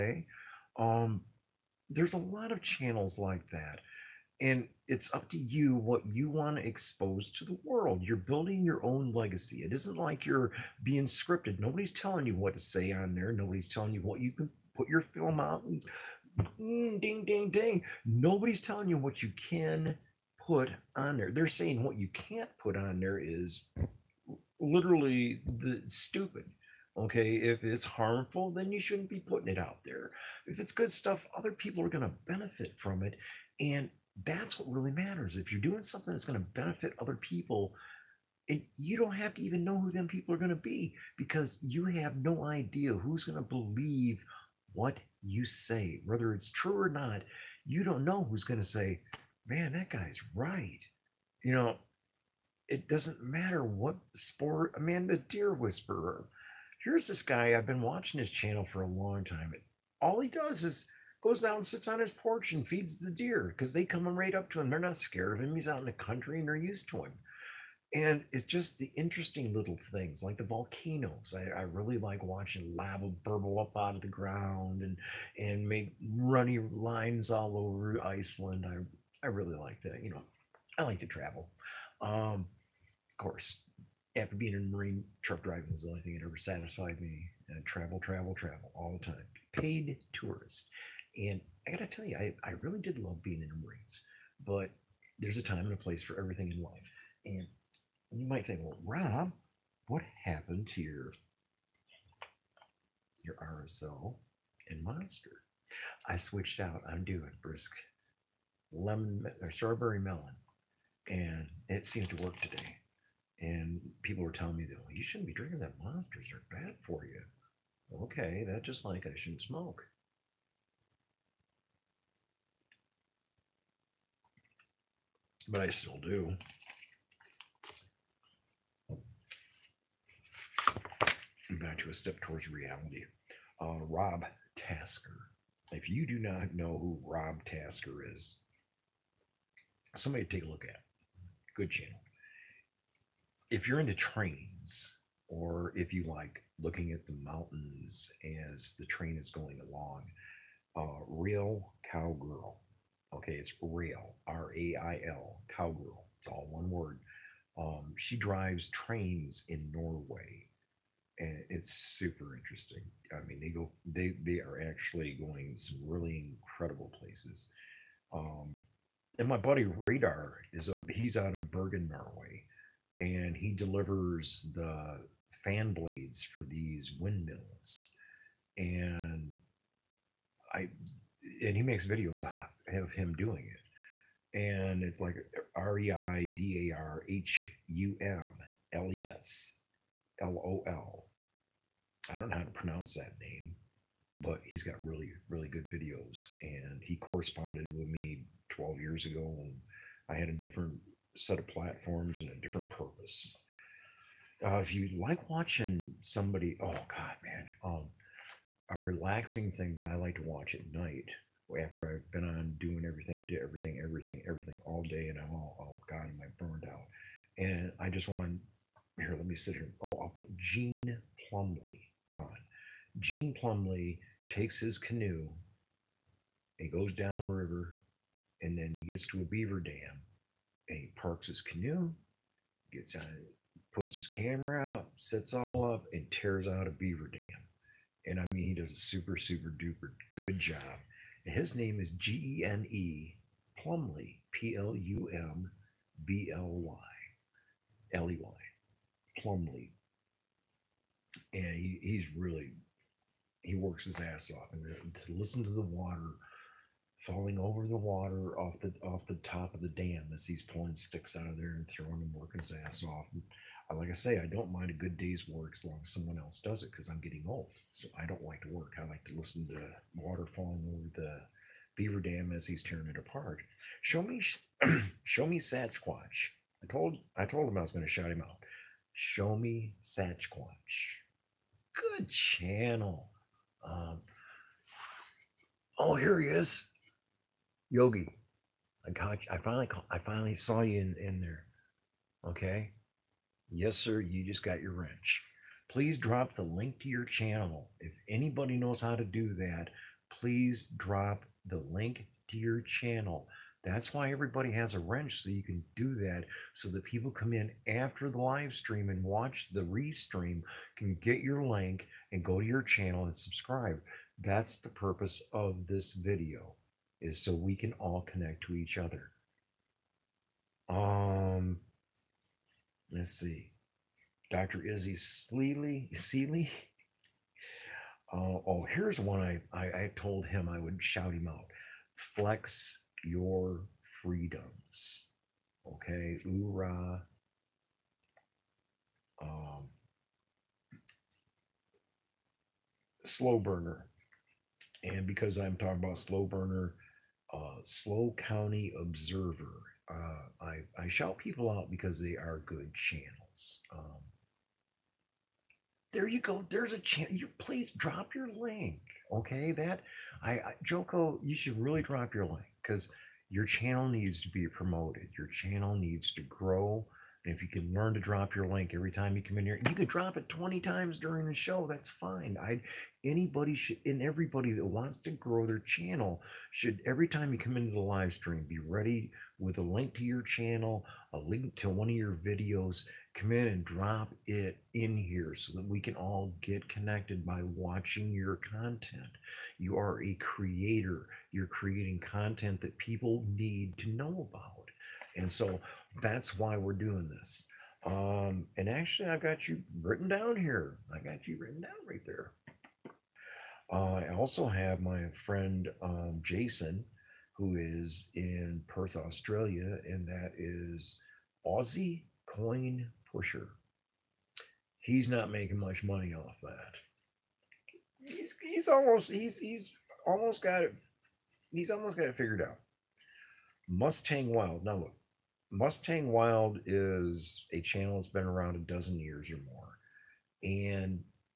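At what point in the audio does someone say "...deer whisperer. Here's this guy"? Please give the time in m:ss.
0:55.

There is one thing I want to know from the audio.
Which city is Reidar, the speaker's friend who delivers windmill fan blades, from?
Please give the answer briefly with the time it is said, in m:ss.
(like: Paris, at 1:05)
Bergen, at 2:51.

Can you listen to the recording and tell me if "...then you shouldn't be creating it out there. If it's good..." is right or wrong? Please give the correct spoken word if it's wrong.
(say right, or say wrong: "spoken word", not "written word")
wrong: "putting", not "creating".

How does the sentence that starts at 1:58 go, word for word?
Okay, that just like I shouldn't smoke.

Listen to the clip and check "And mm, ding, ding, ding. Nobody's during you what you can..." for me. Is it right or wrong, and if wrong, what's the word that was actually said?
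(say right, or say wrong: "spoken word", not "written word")
wrong: "telling", not "during".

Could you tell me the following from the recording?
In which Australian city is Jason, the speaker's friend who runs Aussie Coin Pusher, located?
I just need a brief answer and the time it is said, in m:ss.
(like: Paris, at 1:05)
Perth, at 6:48.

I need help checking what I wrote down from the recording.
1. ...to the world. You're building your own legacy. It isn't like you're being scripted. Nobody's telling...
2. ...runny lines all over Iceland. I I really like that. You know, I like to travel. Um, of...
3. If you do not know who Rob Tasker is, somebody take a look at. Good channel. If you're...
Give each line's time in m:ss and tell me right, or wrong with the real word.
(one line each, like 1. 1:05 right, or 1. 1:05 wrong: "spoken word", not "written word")
1. 0:07 right
2. 1:16 right
3. 2:15 right.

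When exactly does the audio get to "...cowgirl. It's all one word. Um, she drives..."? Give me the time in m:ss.
2:35.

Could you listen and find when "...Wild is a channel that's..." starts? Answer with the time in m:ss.
7:06.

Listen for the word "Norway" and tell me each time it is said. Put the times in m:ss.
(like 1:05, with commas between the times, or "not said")
2:39, 2:51.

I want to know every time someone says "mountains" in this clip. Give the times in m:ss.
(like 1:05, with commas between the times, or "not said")
2:27.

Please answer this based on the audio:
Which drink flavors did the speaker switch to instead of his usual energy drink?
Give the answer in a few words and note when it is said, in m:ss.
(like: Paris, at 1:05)
Brisk lemon or strawberry melon, at 1:47.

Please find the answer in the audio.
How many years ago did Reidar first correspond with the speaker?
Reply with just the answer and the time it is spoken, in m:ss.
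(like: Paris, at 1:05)
12, at 3:18.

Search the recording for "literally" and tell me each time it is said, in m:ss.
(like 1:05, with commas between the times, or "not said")
0:24.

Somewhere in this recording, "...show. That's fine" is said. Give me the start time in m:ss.
6:11.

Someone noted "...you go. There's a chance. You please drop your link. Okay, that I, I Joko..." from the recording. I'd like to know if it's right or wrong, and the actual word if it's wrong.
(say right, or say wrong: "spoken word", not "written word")
right.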